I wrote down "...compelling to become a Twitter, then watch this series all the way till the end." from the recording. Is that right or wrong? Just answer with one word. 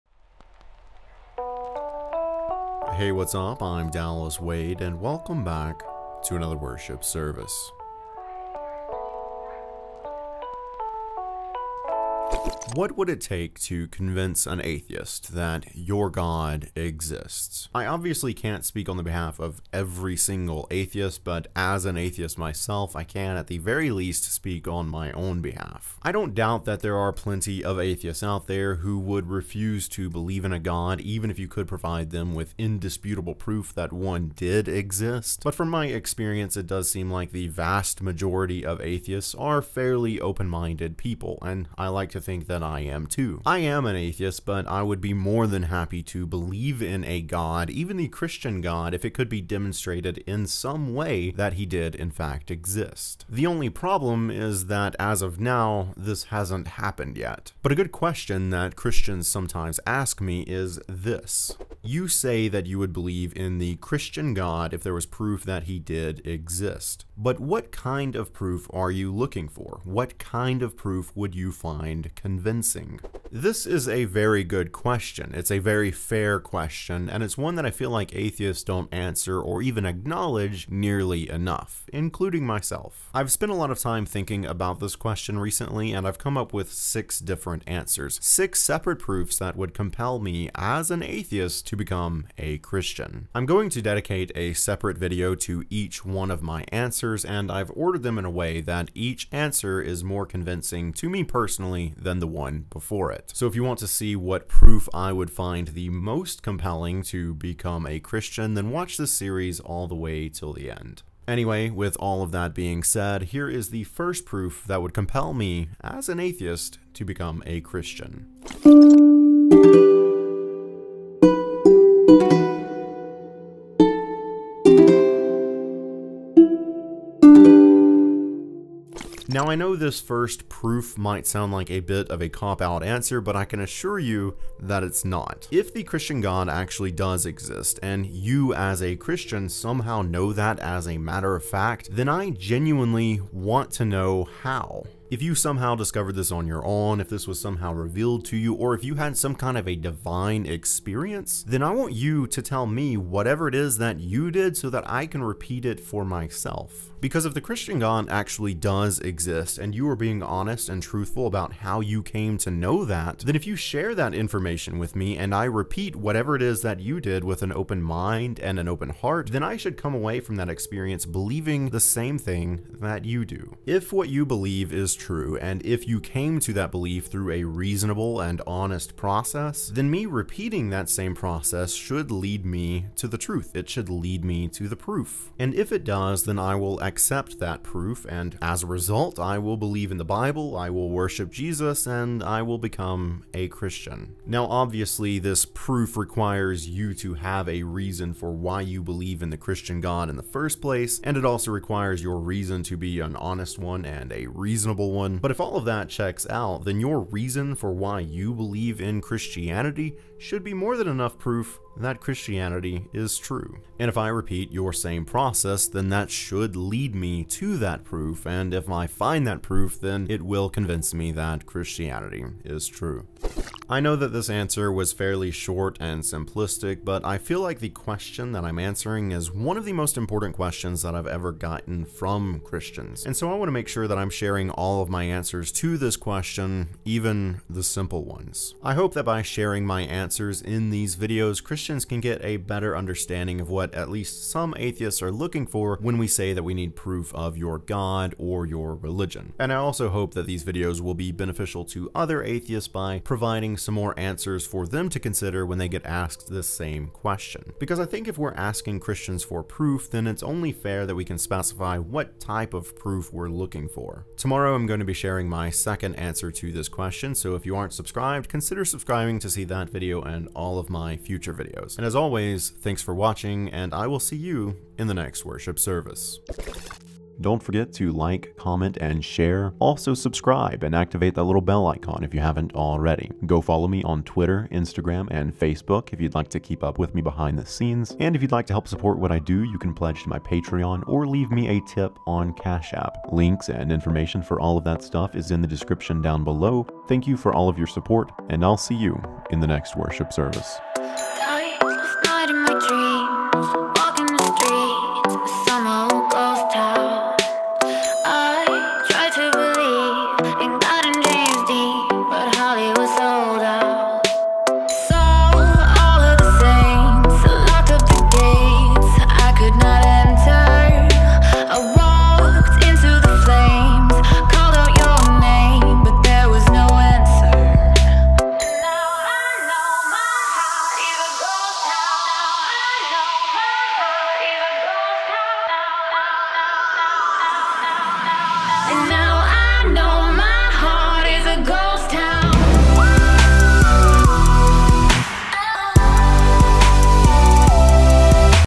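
wrong.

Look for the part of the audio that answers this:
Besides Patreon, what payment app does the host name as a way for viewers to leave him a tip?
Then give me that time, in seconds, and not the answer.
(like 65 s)
292 s.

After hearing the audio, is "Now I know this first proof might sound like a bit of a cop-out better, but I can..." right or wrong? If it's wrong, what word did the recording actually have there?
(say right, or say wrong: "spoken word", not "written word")
wrong: "answer", not "better".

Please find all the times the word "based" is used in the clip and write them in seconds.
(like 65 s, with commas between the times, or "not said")
not said.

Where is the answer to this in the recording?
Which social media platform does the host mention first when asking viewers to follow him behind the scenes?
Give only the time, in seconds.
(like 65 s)
284 s.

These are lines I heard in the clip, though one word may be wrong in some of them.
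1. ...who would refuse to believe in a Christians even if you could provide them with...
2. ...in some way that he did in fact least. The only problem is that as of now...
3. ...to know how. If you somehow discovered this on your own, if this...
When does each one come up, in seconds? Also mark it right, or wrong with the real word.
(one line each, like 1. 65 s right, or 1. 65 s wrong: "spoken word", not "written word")
1. 28 s wrong: "God", not "Christians"
2. 50 s wrong: "exist", not "least"
3. 143 s right.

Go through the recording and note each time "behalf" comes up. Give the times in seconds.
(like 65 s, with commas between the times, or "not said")
19 s, 25 s.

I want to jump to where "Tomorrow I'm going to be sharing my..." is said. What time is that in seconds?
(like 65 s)
264 s.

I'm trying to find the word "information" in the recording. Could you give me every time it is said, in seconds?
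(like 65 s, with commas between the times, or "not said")
164 s, 293 s.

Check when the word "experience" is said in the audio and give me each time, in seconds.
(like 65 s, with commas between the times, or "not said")
35 s, 150 s, 170 s.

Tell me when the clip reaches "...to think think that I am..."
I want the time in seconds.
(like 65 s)
42 s.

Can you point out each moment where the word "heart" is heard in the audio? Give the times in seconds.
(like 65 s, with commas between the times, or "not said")
168 s.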